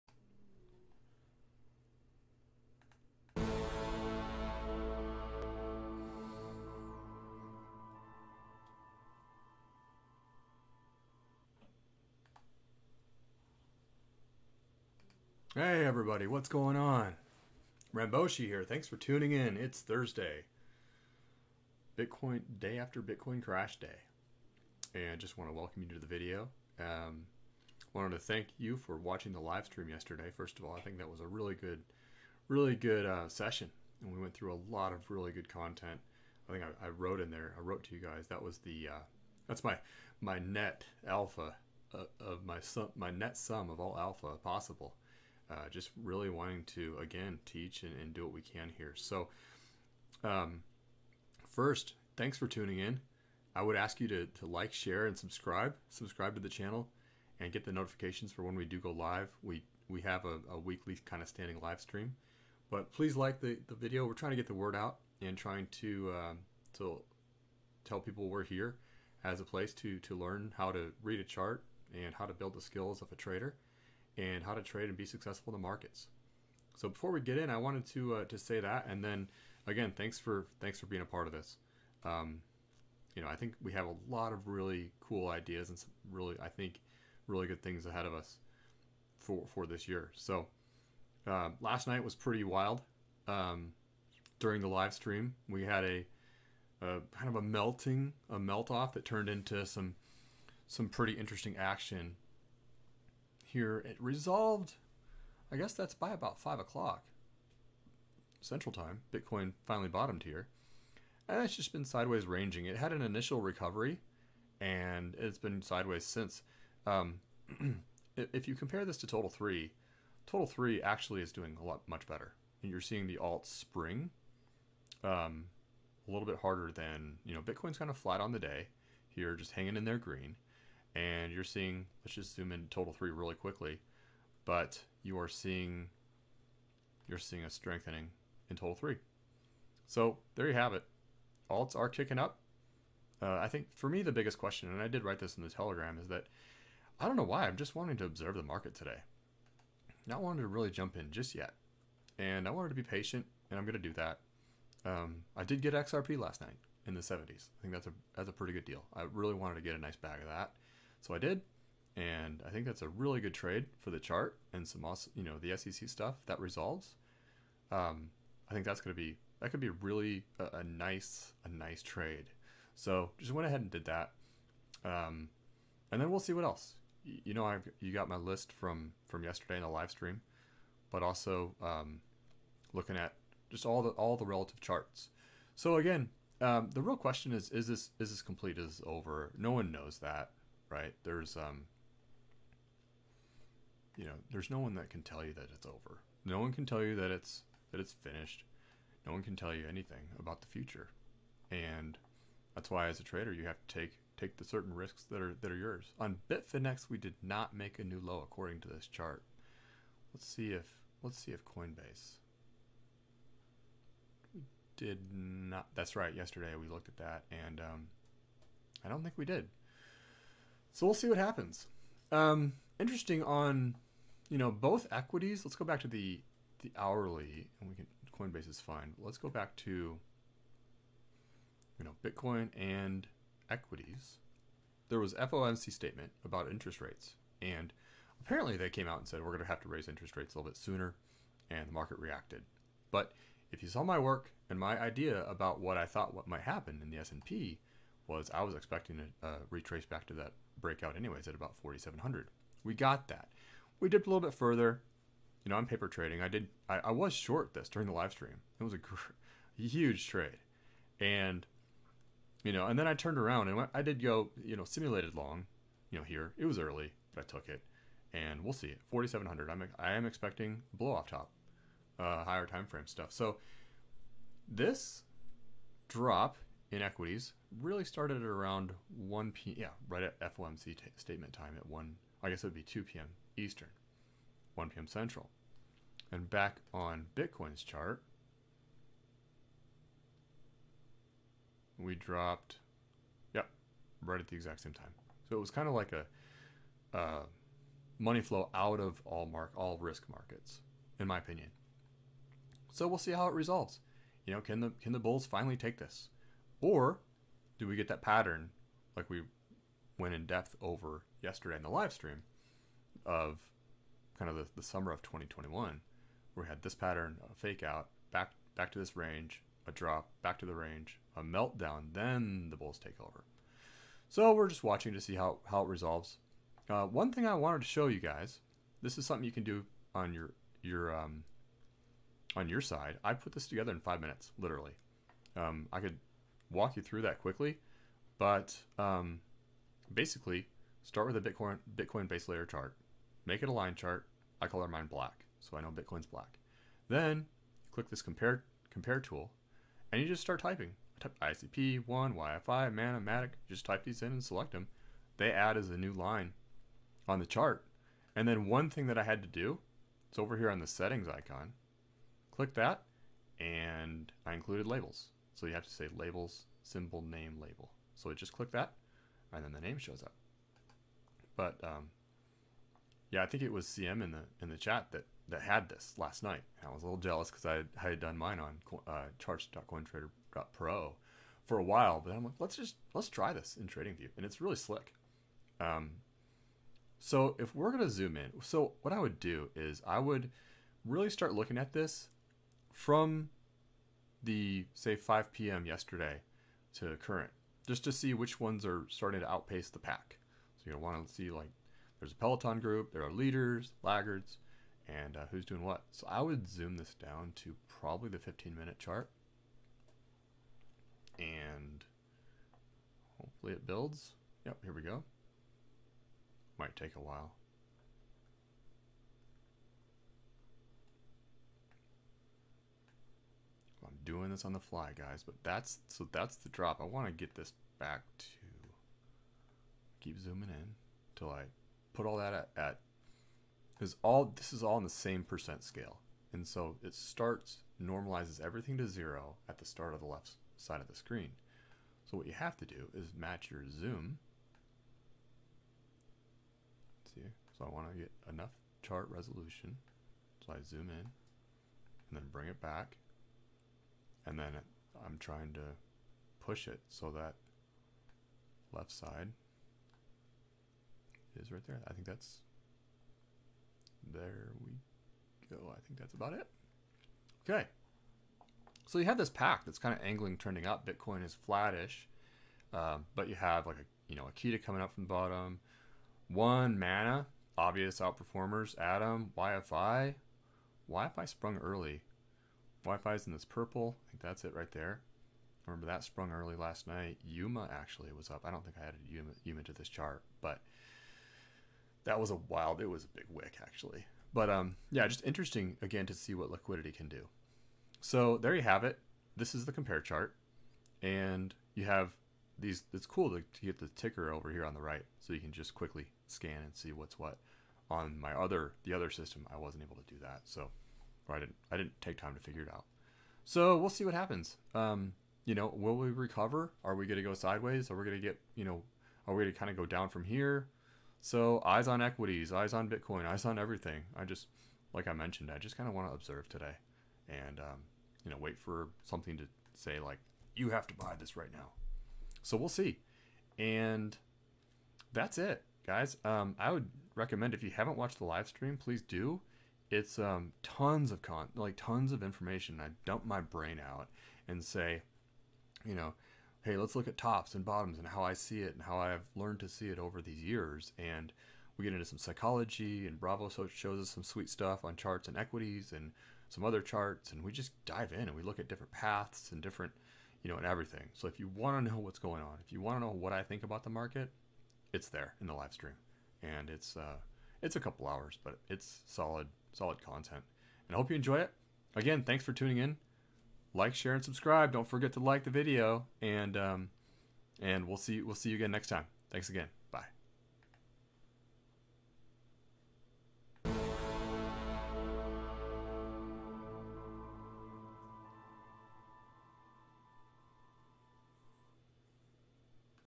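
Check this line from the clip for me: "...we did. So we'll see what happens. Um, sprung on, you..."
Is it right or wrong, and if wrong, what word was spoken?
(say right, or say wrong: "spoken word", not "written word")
wrong: "interesting", not "sprung".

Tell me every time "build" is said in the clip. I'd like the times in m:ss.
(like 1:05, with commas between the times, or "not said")
1:12, 6:53.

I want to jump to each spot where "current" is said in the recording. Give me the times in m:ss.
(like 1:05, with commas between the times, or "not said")
6:37.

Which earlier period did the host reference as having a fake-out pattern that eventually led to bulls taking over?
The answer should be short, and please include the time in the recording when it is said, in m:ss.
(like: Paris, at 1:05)
summer of 2021, at 5:14.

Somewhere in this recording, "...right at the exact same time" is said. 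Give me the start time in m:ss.
4:54.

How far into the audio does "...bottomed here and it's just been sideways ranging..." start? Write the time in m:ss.
1:49.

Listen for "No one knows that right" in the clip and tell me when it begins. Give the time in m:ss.
3:09.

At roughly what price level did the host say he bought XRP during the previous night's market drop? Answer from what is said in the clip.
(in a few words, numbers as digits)
in the 70s.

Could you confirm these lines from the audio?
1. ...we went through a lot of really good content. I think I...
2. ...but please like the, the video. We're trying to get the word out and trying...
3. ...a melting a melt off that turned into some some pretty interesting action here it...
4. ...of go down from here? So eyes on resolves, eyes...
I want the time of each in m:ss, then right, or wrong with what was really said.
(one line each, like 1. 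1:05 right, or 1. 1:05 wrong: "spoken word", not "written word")
1. 0:34 right
2. 1:02 right
3. 1:37 right
4. 8:39 wrong: "equities", not "resolves".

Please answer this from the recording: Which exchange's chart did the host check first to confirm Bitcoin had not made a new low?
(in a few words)
Bitfinex.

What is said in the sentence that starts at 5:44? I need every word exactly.
I color mine black, so I know Bitcoin's black.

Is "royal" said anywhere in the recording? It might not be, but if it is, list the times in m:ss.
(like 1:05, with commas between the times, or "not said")
not said.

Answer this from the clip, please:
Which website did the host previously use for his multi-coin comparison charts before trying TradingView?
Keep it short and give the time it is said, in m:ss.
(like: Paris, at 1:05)
charts.cointrader.pro, at 6:19.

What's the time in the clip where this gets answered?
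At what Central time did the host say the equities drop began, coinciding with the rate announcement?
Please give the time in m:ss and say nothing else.
4:44.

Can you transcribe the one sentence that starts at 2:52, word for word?
So just went ahead and did that, um, and then we'll see what else.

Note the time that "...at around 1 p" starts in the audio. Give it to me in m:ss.
4:38.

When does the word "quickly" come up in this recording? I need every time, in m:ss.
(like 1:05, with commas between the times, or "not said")
2:13, 5:37, 8:25.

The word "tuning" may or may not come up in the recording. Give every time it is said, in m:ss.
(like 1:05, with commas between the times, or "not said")
0:18, 0:52, 9:32.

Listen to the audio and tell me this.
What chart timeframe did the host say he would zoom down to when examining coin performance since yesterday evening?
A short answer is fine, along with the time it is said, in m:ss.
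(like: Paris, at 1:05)
15 minute, at 6:48.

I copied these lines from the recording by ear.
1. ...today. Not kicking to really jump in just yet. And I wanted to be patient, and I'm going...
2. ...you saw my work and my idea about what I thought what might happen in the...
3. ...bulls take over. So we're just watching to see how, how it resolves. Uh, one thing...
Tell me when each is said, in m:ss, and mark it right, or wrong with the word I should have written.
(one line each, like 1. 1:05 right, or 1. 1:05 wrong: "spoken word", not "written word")
1. 2:28 wrong: "wanting", not "kicking"
2. 4:03 right
3. 5:22 right.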